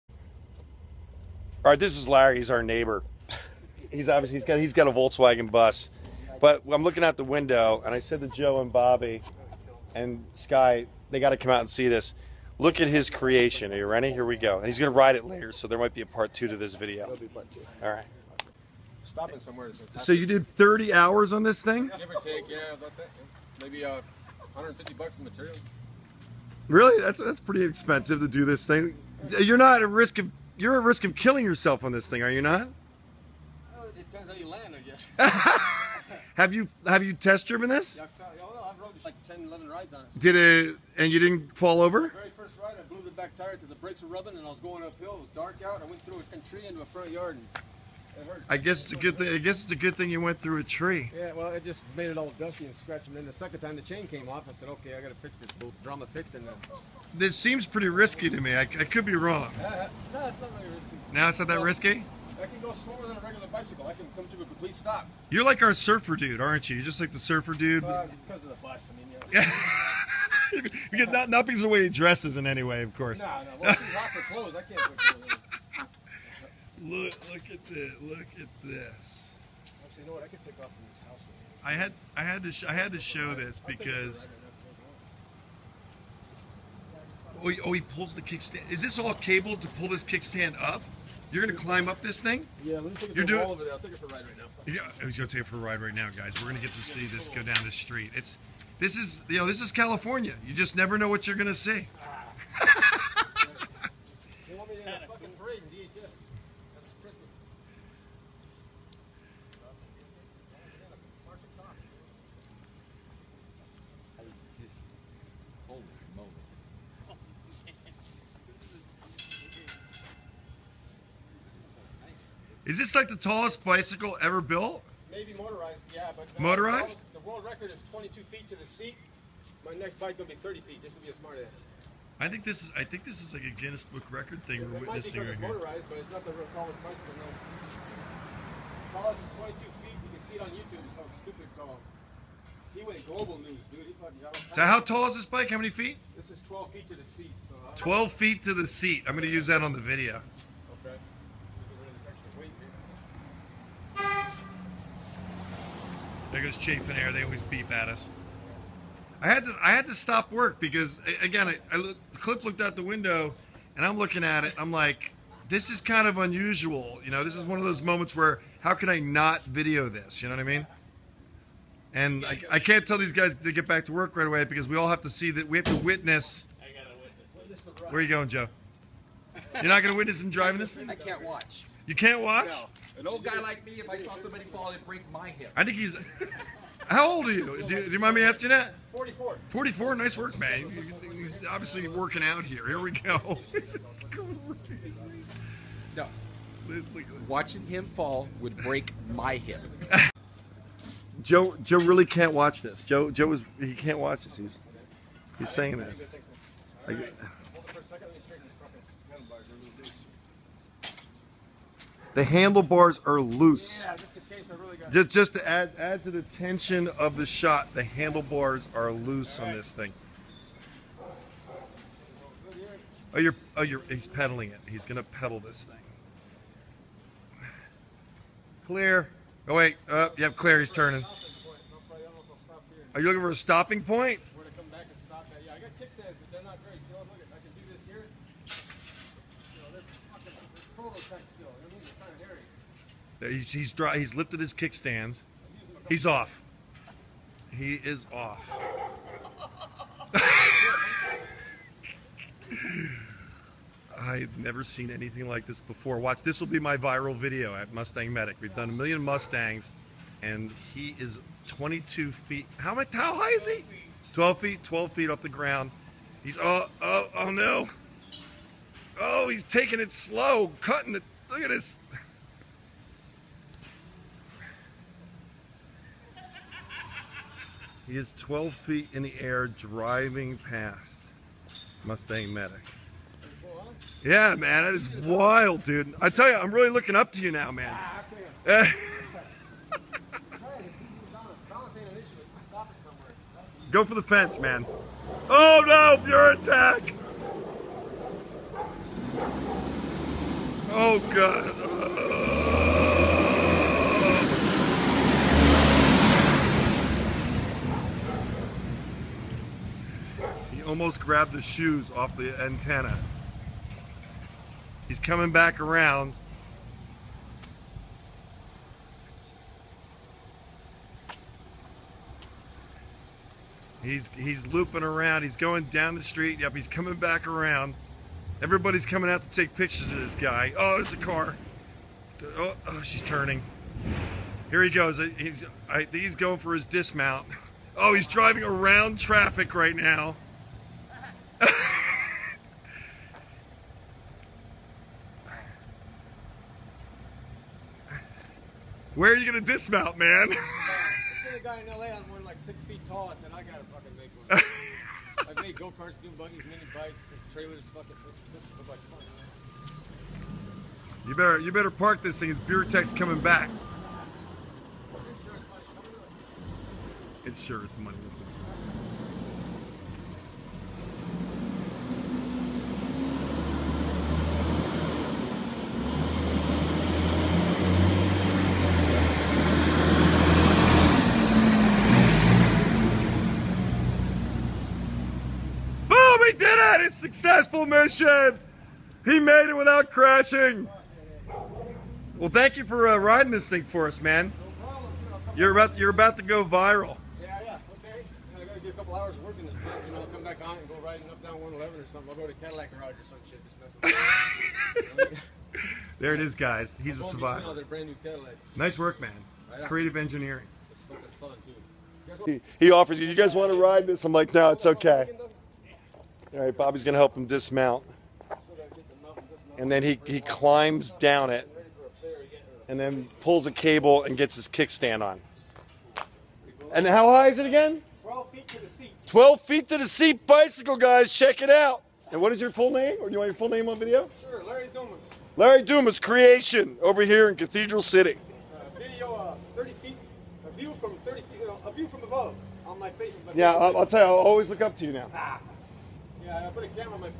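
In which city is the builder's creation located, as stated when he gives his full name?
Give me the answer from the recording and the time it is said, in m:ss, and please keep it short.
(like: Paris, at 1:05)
Cathedral City, at 7:17.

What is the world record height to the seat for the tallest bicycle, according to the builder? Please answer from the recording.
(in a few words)
22 feet.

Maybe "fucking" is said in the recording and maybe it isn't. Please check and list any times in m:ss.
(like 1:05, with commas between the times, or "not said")
2:23, 5:53, 5:57.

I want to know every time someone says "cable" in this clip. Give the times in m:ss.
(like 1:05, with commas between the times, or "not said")
1:29, 7:03.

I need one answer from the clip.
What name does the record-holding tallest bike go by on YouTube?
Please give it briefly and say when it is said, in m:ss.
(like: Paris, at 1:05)
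Stupid tall, at 2:21.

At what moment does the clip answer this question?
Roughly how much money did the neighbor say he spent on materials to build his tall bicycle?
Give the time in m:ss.
0:24.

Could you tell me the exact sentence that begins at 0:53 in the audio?
And then the second time the chain came off, I said, "Okay, I got to fix this boot.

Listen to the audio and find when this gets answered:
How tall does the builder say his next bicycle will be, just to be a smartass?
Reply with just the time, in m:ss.
2:09.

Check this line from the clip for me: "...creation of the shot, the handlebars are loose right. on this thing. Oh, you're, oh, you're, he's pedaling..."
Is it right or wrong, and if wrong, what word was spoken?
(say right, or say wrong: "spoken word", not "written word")
wrong: "tension", not "creation".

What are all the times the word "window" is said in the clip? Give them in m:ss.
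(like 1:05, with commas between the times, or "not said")
0:07, 2:42.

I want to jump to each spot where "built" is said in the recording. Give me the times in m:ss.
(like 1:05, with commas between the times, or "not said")
2:04.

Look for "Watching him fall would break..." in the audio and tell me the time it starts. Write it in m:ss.
3:17.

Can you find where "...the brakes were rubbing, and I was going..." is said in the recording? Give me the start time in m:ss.
0:43.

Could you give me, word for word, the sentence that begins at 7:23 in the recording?
Yeah, I'll, I'll, tell you, I'll always look up to you now.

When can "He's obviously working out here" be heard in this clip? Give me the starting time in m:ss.
3:11.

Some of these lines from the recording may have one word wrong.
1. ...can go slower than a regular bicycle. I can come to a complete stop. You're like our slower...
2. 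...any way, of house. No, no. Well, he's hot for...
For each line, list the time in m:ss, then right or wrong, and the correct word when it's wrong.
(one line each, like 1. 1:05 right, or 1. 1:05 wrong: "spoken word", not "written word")
1. 1:02 wrong: "surfer", not "slower"
2. 1:12 wrong: "course", not "house".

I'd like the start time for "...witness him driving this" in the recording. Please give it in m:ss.
2:59.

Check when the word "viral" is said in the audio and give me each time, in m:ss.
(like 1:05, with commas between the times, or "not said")
4:16, 6:36.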